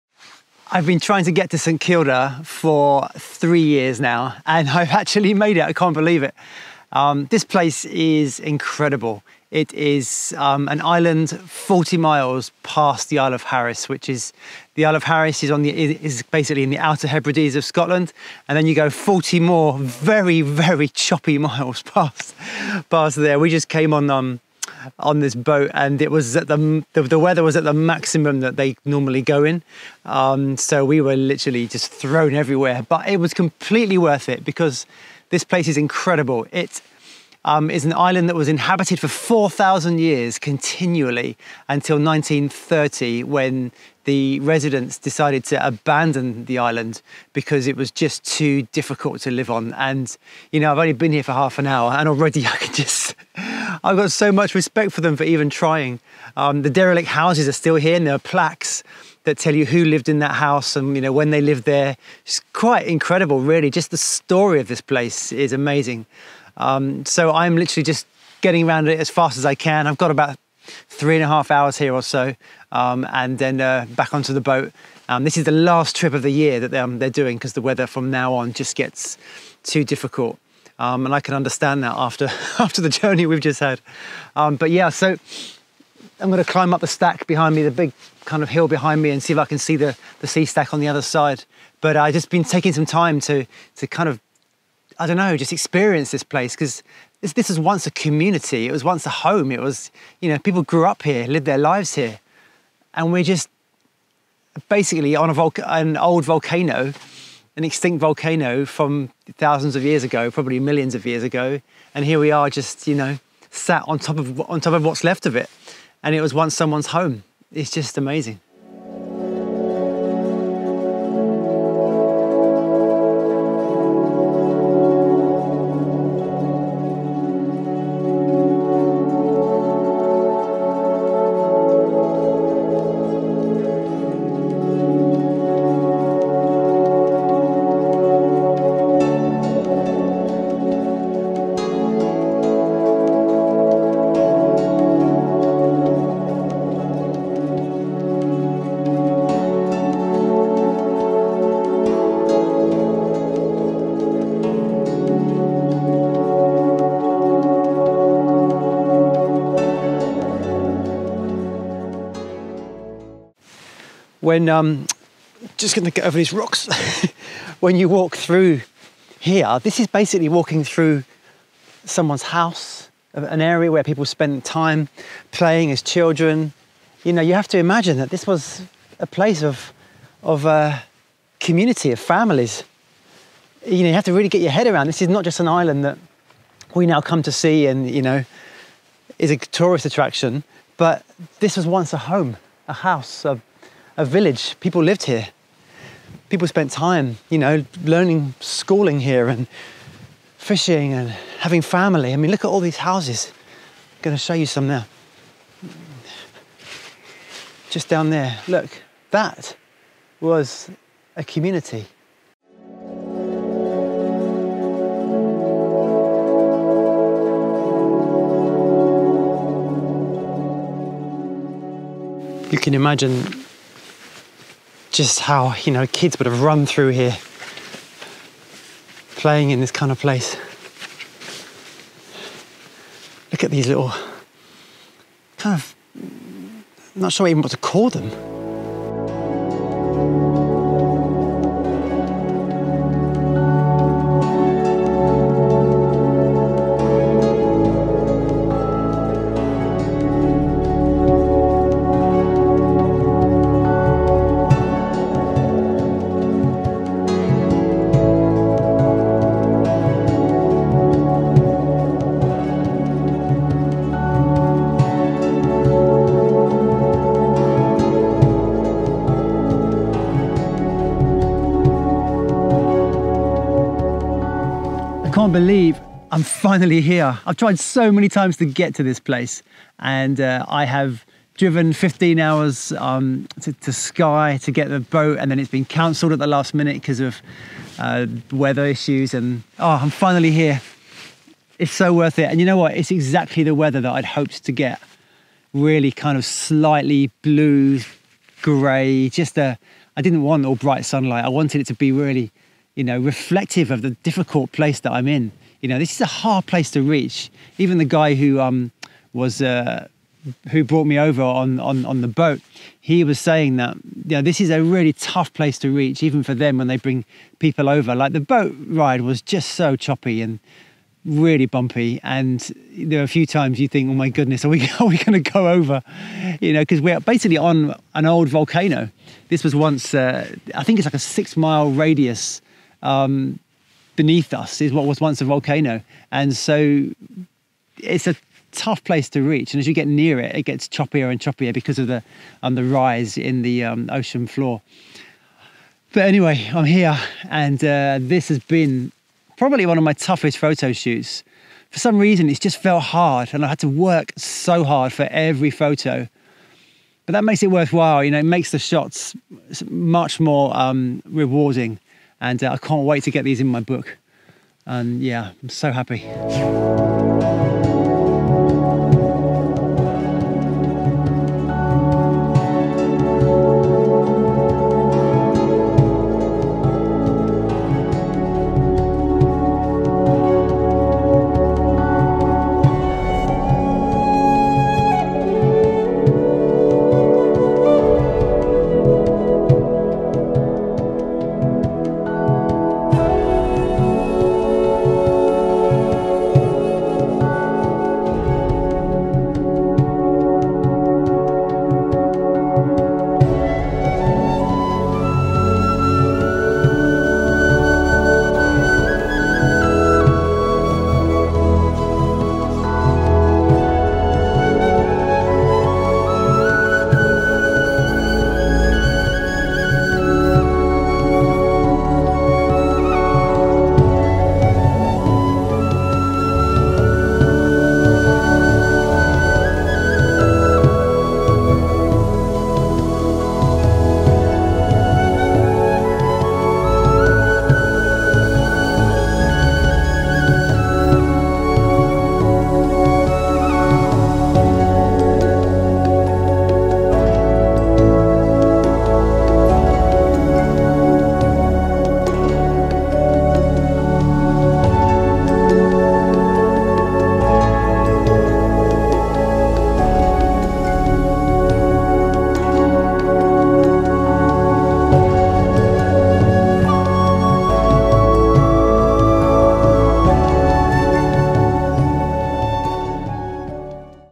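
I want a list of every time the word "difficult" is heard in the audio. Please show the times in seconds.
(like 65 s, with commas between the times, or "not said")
48 s, 79 s, 304 s.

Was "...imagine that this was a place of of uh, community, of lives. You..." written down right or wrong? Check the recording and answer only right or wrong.
wrong.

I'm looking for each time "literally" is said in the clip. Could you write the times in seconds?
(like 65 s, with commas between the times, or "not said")
31 s, 67 s.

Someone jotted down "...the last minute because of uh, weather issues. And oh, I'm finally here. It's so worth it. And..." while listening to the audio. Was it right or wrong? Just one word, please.
right.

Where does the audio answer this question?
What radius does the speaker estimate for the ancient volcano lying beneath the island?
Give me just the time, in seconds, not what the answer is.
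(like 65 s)
330 s.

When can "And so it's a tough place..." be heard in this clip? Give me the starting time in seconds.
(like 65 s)
336 s.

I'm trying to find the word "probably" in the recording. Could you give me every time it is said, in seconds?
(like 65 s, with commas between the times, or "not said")
110 s, 349 s.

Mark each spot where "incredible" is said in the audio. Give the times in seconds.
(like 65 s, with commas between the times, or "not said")
8 s, 35 s, 62 s.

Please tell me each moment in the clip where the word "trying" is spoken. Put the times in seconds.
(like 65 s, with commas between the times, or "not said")
1 s, 55 s.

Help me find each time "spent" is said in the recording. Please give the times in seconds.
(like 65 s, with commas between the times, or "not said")
174 s, 196 s.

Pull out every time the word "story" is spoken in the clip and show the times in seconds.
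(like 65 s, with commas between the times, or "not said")
63 s.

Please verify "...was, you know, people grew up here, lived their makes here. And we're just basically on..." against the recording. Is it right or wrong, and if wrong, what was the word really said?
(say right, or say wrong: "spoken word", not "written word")
wrong: "lives", not "makes".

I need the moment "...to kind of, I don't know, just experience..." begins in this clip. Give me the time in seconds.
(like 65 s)
93 s.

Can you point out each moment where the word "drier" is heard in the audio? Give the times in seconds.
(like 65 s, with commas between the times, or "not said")
not said.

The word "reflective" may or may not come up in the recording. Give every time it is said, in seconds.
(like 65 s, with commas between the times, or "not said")
302 s.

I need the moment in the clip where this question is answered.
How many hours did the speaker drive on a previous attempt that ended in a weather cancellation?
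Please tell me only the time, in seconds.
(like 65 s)
281 s.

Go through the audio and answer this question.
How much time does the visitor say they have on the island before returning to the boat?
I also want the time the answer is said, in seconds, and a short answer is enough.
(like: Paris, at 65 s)
3.5 hours, at 70 s.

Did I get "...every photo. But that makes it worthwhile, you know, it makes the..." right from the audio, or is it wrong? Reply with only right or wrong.
right.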